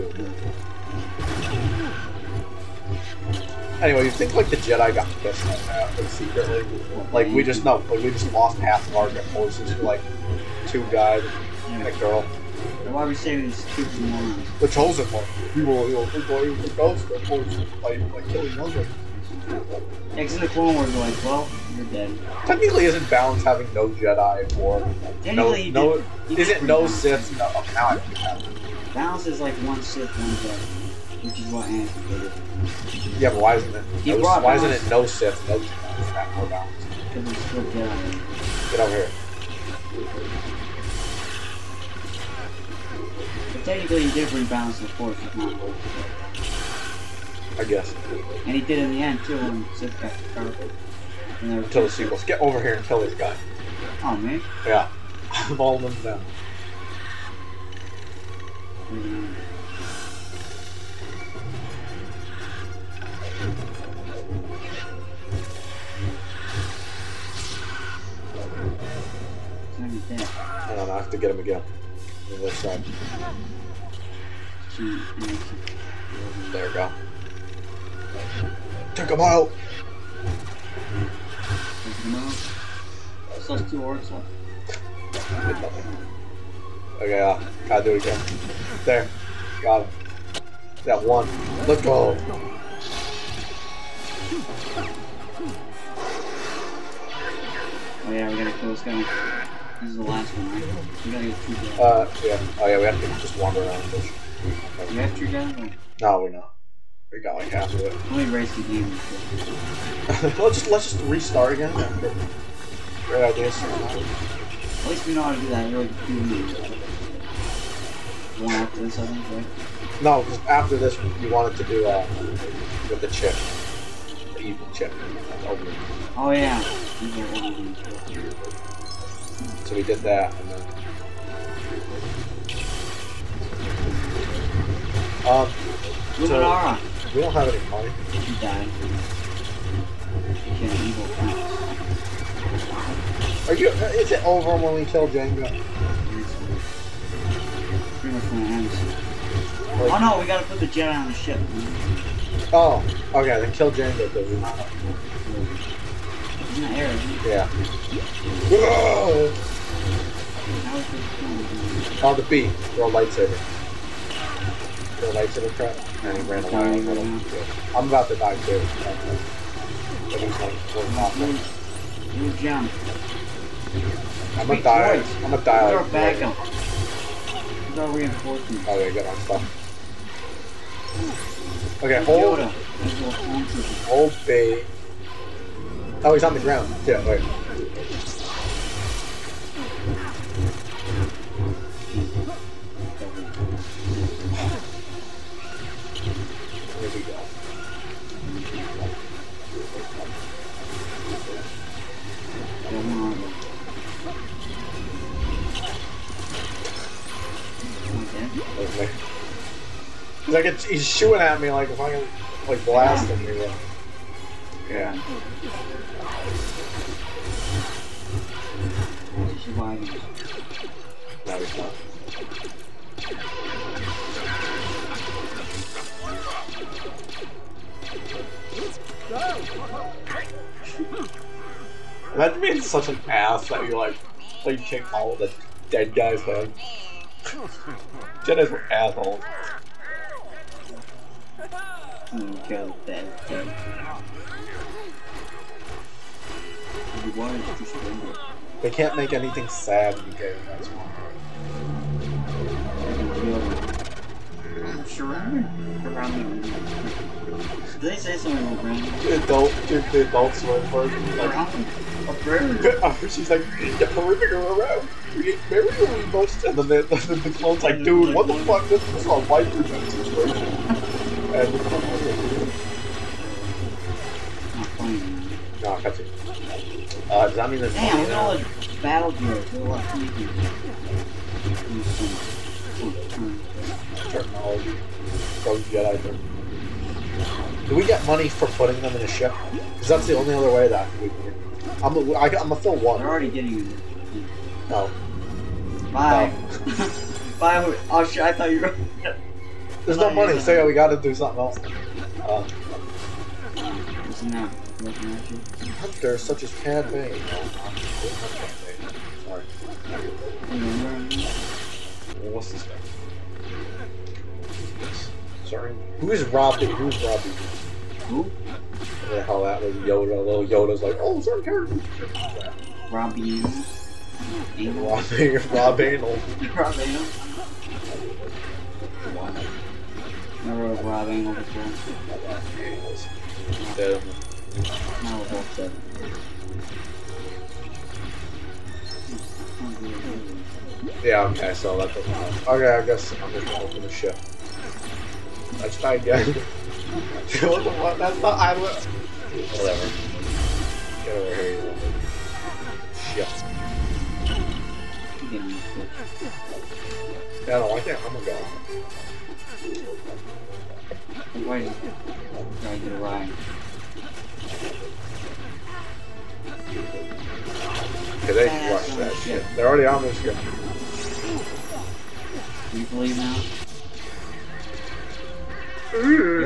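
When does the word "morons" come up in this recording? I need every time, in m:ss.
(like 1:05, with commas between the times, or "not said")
0:14.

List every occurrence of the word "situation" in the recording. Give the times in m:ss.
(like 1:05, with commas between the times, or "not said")
4:29.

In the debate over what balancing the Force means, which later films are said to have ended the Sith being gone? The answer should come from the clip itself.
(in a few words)
the sequels.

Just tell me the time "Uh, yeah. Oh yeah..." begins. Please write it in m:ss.
1:41.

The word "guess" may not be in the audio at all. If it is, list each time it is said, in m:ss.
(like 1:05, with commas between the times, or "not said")
0:47, 5:42.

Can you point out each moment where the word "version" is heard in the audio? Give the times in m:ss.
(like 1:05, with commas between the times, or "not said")
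4:20.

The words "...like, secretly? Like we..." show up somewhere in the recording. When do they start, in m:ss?
0:05.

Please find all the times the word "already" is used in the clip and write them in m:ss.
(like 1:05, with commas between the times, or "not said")
4:53, 6:09.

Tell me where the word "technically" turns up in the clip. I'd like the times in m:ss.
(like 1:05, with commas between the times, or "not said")
0:22, 0:43.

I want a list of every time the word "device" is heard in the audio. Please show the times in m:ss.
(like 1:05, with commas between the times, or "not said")
not said.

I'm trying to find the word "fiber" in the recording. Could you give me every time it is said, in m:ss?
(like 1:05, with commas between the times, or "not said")
not said.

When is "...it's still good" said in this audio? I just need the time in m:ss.
0:37.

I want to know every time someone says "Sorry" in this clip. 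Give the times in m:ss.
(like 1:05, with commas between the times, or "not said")
5:09, 5:15.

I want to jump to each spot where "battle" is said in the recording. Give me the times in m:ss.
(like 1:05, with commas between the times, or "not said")
4:38.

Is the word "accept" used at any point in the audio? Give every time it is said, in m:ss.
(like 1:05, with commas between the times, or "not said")
not said.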